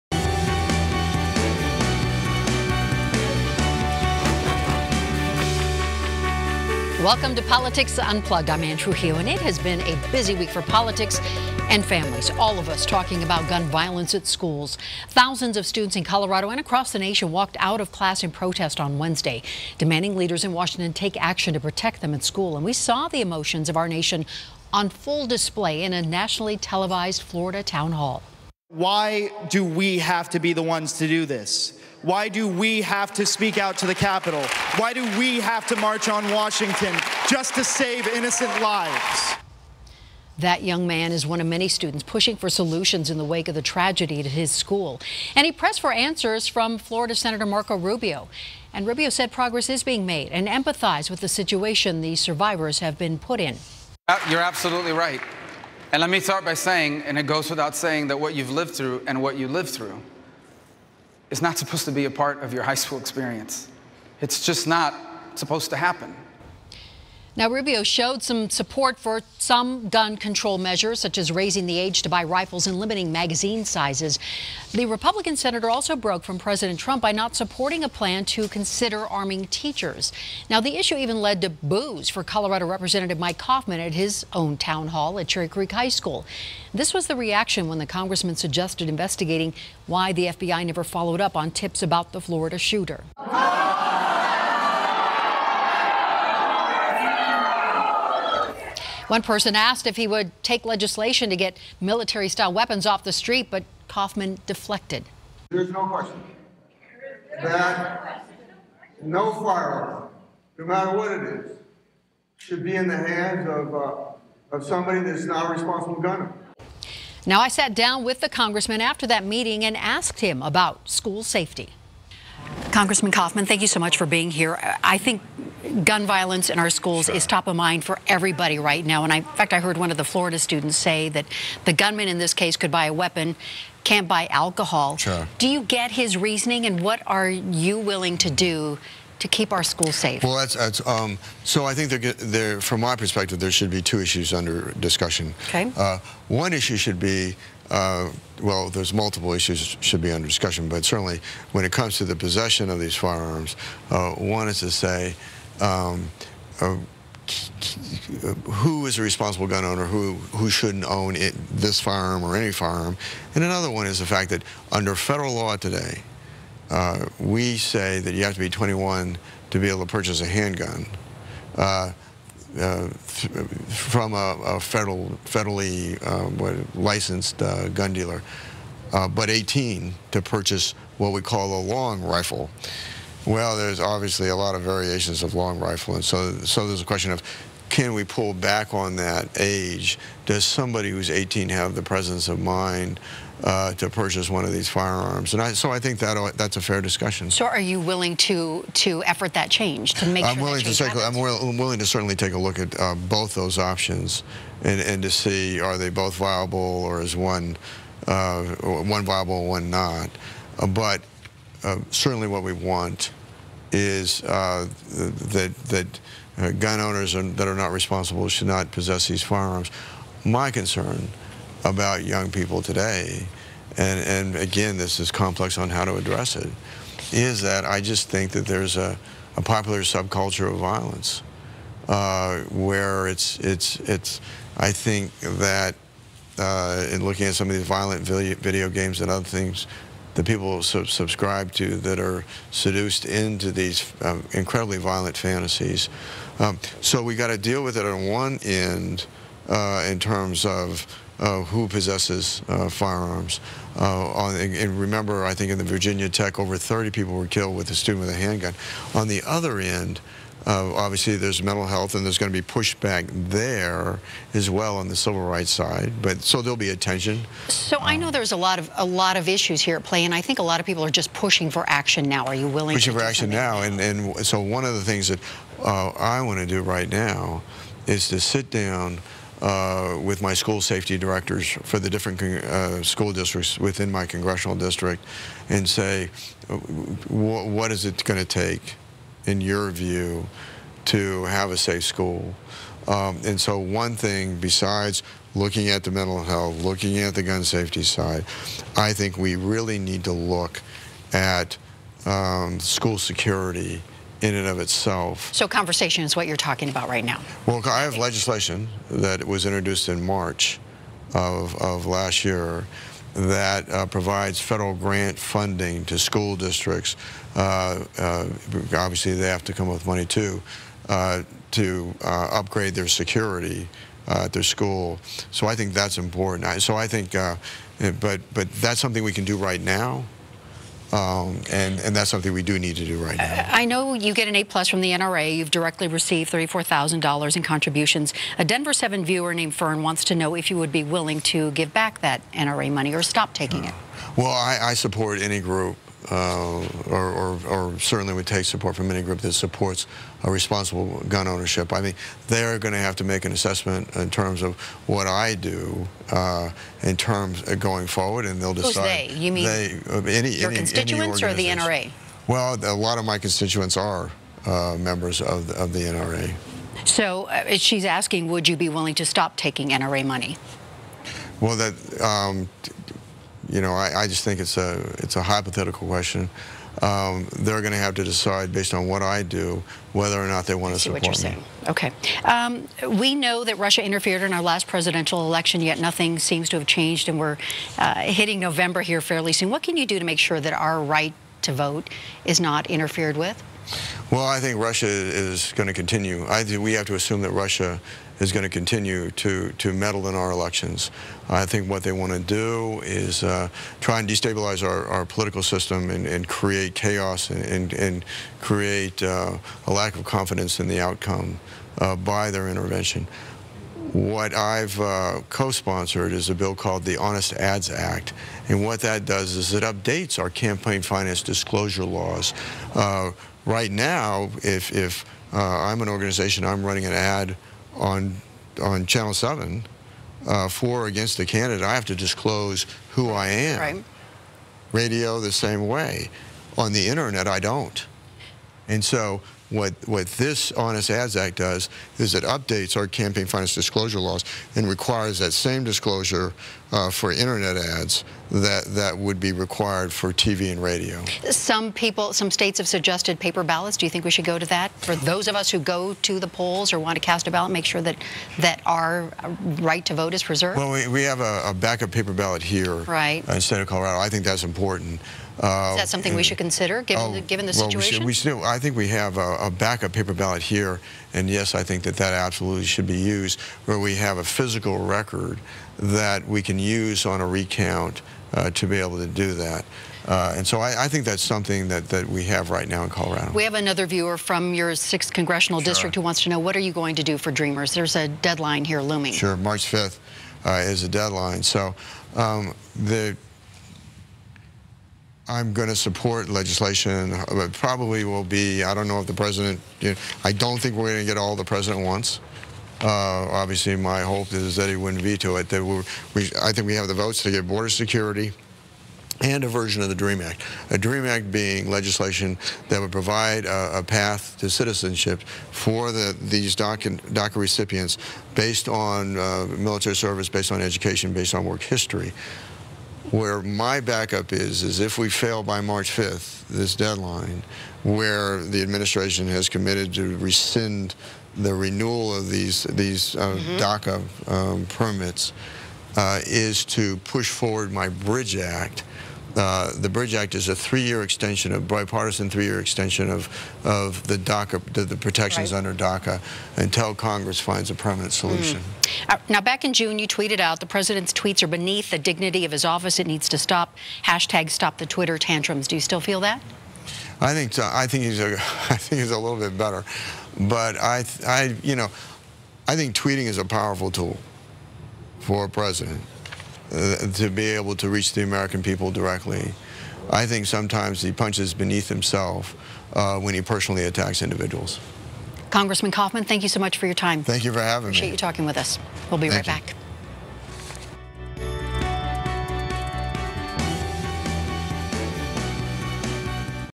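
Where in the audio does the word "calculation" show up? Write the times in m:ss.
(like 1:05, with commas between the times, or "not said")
not said.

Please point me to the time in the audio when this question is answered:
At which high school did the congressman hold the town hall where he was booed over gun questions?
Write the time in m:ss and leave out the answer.
1:25.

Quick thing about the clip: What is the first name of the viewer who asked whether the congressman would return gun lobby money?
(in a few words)
Fern.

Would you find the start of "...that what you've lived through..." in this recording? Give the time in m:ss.
0:58.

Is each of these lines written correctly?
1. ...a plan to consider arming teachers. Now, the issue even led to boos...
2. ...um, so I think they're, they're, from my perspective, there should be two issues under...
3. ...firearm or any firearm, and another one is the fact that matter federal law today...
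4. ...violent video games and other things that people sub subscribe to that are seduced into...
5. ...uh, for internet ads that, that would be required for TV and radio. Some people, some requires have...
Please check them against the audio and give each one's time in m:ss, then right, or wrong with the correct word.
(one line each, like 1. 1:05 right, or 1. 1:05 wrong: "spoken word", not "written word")
1. 1:17 right
2. 2:20 right
3. 2:41 wrong: "under", not "matter"
4. 3:57 right
5. 7:26 wrong: "states", not "requires".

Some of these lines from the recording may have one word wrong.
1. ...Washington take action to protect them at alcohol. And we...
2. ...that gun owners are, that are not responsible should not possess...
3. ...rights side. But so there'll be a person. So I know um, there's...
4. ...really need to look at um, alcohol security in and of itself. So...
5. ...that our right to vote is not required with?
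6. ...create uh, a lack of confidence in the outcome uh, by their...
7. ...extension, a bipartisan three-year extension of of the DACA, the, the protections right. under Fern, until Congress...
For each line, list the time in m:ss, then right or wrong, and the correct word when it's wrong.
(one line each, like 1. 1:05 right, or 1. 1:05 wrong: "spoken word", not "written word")
1. 0:20 wrong: "school", not "alcohol"
2. 3:35 right
3. 4:25 wrong: "tension", not "person"
4. 4:59 wrong: "school", not "alcohol"
5. 6:30 wrong: "interfered", not "required"
6. 6:48 right
7. 9:01 wrong: "DACA", not "Fern".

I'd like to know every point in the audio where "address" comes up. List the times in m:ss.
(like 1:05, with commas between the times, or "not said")
3:45.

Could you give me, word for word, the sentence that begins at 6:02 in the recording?
Well, a lot of my constituents are uh, members of the, of the NRA.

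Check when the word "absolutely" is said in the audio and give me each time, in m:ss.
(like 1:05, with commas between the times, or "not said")
0:54, 7:52.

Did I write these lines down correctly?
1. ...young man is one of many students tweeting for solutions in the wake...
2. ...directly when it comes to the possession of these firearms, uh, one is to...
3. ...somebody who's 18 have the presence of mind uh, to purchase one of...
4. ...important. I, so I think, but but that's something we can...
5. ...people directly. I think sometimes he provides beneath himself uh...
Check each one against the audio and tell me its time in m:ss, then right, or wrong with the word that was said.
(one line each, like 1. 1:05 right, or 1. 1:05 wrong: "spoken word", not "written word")
1. 0:40 wrong: "pushing", not "tweeting"
2. 2:30 wrong: "certainly", not "directly"
3. 3:10 right
4. 5:25 right
5. 9:28 wrong: "punches", not "provides".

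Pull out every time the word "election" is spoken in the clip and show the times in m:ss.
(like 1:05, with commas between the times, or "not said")
6:25, 6:40.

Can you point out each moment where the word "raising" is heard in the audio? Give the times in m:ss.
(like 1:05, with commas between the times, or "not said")
1:11.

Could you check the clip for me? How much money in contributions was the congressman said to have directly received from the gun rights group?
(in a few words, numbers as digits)
$34,000.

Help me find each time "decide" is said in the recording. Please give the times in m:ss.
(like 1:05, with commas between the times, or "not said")
5:58, 6:18.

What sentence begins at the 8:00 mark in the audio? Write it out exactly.
Uh, and so I, I, think that's something that, that we have right now in Colorado.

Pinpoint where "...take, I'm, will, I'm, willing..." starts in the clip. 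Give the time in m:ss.
3:20.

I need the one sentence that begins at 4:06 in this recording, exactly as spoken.
Um, so we got to deal with it on one end uh, in terms of uh, who possesses uh, firearms.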